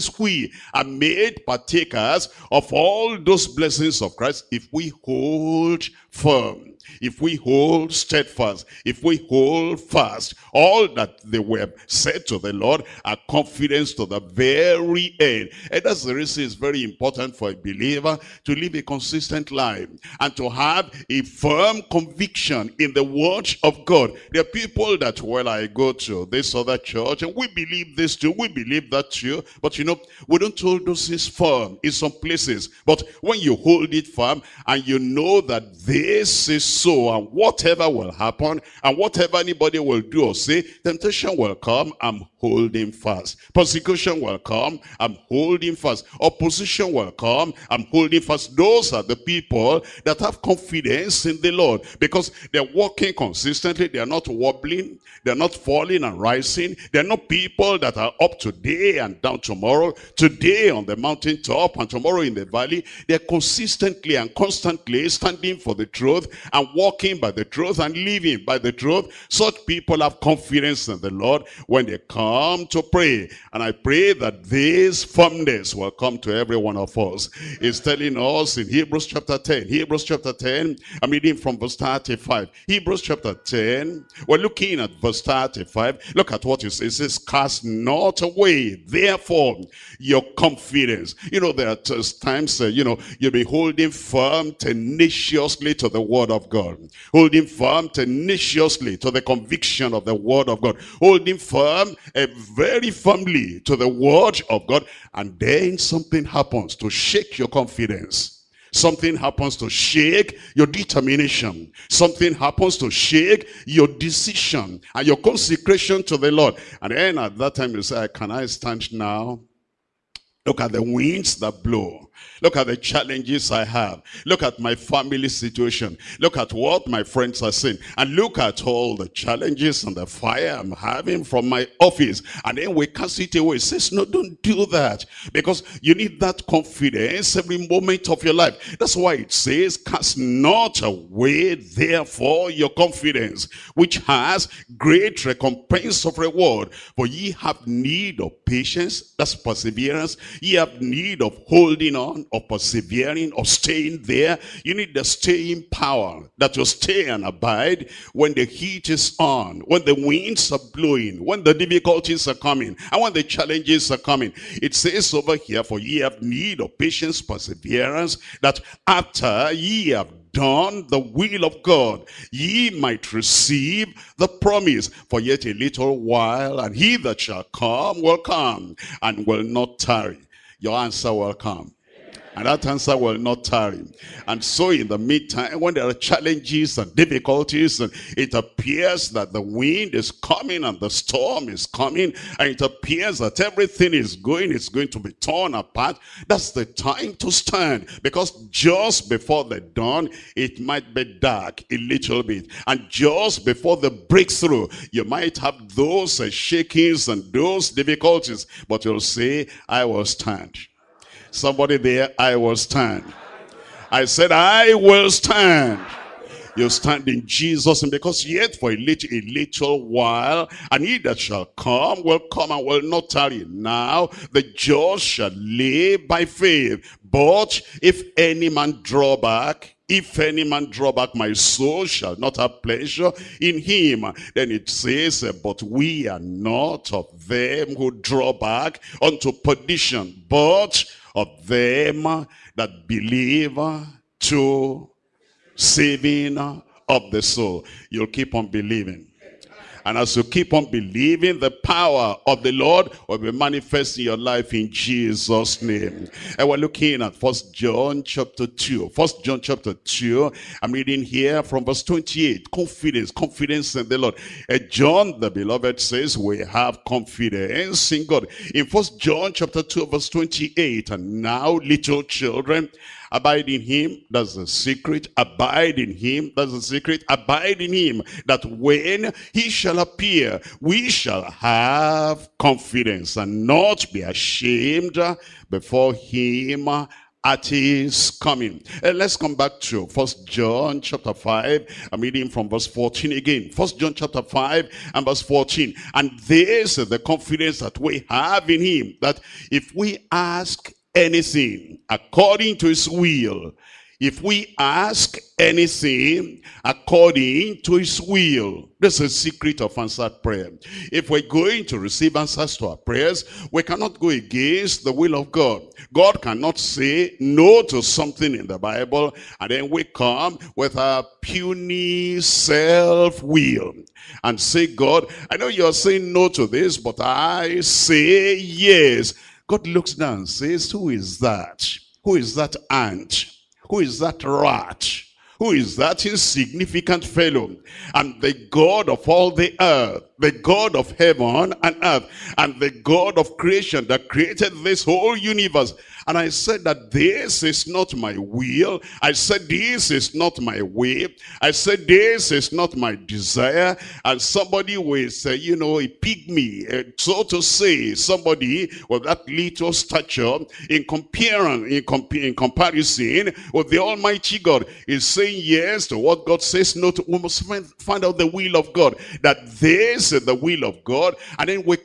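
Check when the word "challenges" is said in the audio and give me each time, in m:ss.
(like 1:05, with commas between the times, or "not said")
2:02, 2:09, 2:43, 3:05.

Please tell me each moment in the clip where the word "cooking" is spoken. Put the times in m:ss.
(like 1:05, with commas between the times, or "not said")
not said.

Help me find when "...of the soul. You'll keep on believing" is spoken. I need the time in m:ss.
4:06.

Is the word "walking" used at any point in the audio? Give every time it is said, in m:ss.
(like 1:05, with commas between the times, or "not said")
0:52, 1:06.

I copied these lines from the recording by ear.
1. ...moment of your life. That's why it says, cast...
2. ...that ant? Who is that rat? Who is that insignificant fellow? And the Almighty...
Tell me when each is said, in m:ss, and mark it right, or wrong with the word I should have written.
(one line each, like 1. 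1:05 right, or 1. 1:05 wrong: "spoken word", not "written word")
1. 2:17 right
2. 5:32 wrong: "God", not "Almighty".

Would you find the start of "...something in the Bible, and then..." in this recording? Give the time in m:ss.
5:17.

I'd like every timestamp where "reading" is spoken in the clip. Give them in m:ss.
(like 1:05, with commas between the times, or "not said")
1:21, 4:20, 4:51.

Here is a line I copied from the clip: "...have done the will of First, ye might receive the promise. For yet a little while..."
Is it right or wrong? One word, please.
wrong.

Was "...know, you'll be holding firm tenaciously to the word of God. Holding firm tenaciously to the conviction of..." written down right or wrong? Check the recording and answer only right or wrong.
right.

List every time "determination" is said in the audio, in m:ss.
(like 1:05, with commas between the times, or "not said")
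1:50.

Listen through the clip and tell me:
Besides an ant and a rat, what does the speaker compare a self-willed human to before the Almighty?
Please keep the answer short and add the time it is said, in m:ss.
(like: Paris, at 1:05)
A pygmy, at 5:55.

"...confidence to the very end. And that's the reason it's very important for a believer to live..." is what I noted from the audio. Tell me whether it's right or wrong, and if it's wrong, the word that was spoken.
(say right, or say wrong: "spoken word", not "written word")
right.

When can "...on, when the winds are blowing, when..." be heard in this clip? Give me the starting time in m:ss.
2:39.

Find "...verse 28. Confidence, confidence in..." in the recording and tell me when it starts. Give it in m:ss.
4:21.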